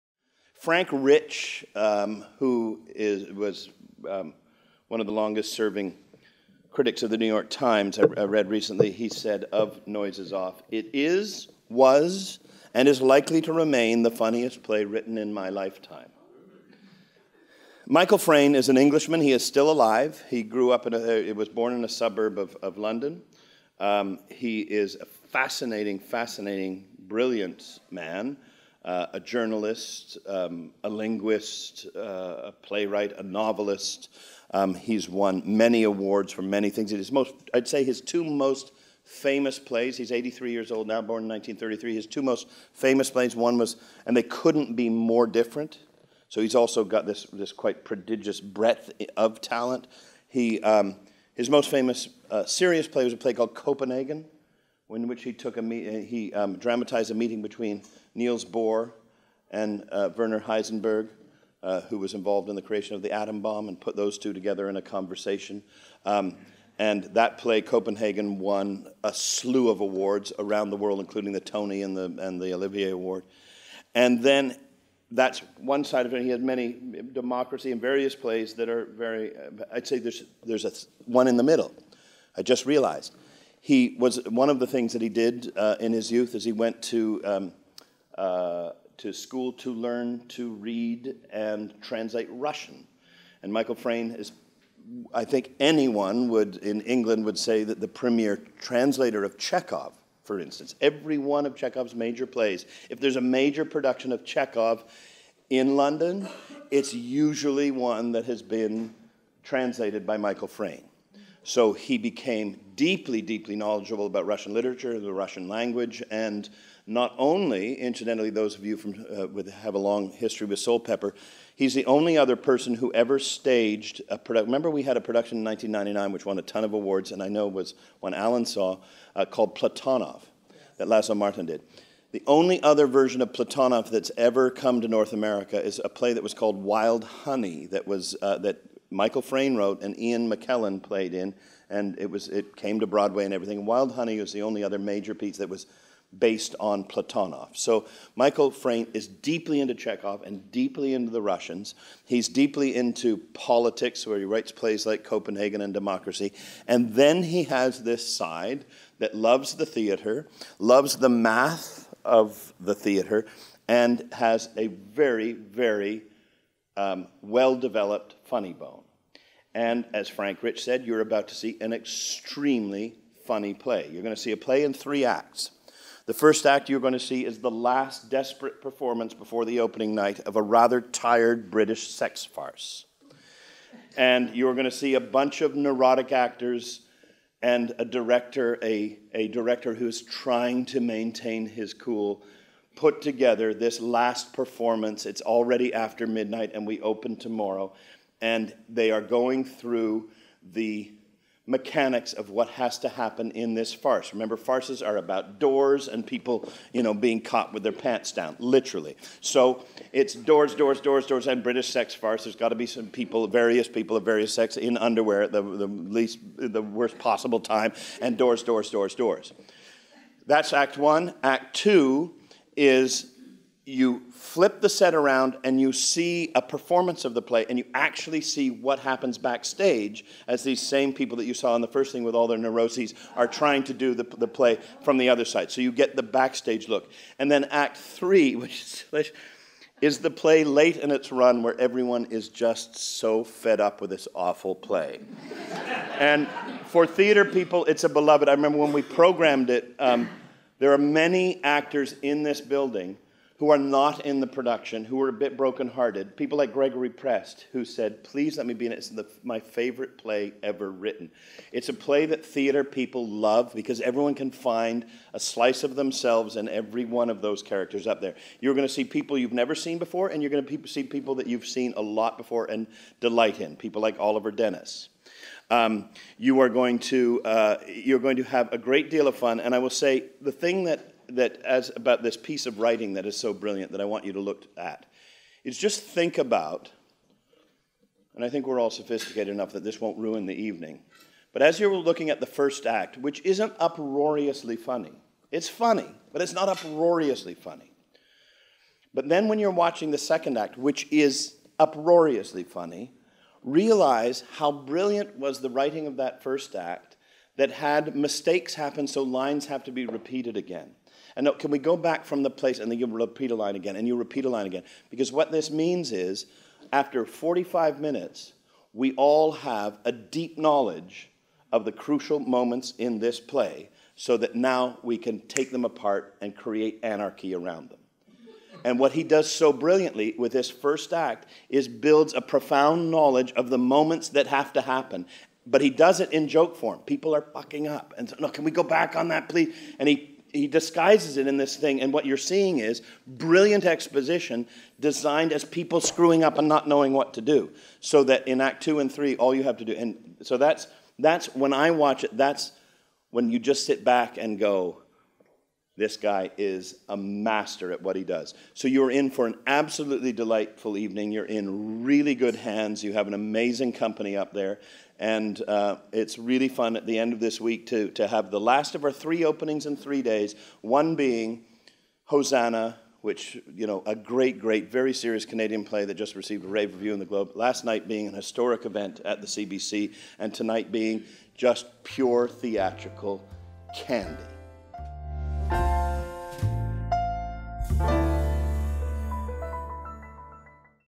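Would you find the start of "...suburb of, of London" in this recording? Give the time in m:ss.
0:21.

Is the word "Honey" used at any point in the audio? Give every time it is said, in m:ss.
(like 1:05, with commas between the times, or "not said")
2:17, 2:23.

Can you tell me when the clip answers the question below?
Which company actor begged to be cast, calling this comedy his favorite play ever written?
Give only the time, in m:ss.
4:16.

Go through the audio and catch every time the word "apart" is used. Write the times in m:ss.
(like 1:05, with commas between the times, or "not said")
5:25.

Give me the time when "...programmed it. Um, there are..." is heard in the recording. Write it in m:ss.
4:08.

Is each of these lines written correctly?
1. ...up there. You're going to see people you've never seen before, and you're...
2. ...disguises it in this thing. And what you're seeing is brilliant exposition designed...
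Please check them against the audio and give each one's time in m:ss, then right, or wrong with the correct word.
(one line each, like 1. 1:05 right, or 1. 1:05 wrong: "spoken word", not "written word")
1. 4:27 right
2. 5:40 right.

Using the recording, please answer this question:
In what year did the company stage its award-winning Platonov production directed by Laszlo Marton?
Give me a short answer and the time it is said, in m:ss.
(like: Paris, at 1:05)
1999, at 2:05.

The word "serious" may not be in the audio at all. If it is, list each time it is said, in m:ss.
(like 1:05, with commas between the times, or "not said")
0:52, 6:14.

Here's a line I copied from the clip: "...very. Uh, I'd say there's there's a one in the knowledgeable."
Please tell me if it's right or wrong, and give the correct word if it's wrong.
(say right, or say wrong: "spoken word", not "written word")
wrong: "middle", not "knowledgeable".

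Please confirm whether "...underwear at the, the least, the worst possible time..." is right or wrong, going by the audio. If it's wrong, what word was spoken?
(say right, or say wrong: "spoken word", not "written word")
right.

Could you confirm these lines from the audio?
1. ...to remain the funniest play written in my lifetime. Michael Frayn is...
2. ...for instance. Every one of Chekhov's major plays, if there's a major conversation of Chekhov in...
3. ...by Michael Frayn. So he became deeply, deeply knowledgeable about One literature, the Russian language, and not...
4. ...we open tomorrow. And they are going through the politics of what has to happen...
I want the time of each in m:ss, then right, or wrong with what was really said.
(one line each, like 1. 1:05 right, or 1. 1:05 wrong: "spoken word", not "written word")
1. 0:13 right
2. 1:40 wrong: "production", not "conversation"
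3. 1:50 wrong: "Russian", not "One"
4. 3:16 wrong: "mechanics", not "politics".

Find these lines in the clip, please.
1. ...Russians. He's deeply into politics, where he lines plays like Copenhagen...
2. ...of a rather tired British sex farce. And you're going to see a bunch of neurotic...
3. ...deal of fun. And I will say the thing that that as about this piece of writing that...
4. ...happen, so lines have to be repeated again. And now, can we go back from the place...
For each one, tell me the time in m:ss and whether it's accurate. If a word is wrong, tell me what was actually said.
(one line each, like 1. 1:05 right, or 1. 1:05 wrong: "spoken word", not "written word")
1. 2:31 wrong: "writes", not "lines"
2. 3:00 right
3. 4:38 right
4. 5:08 right.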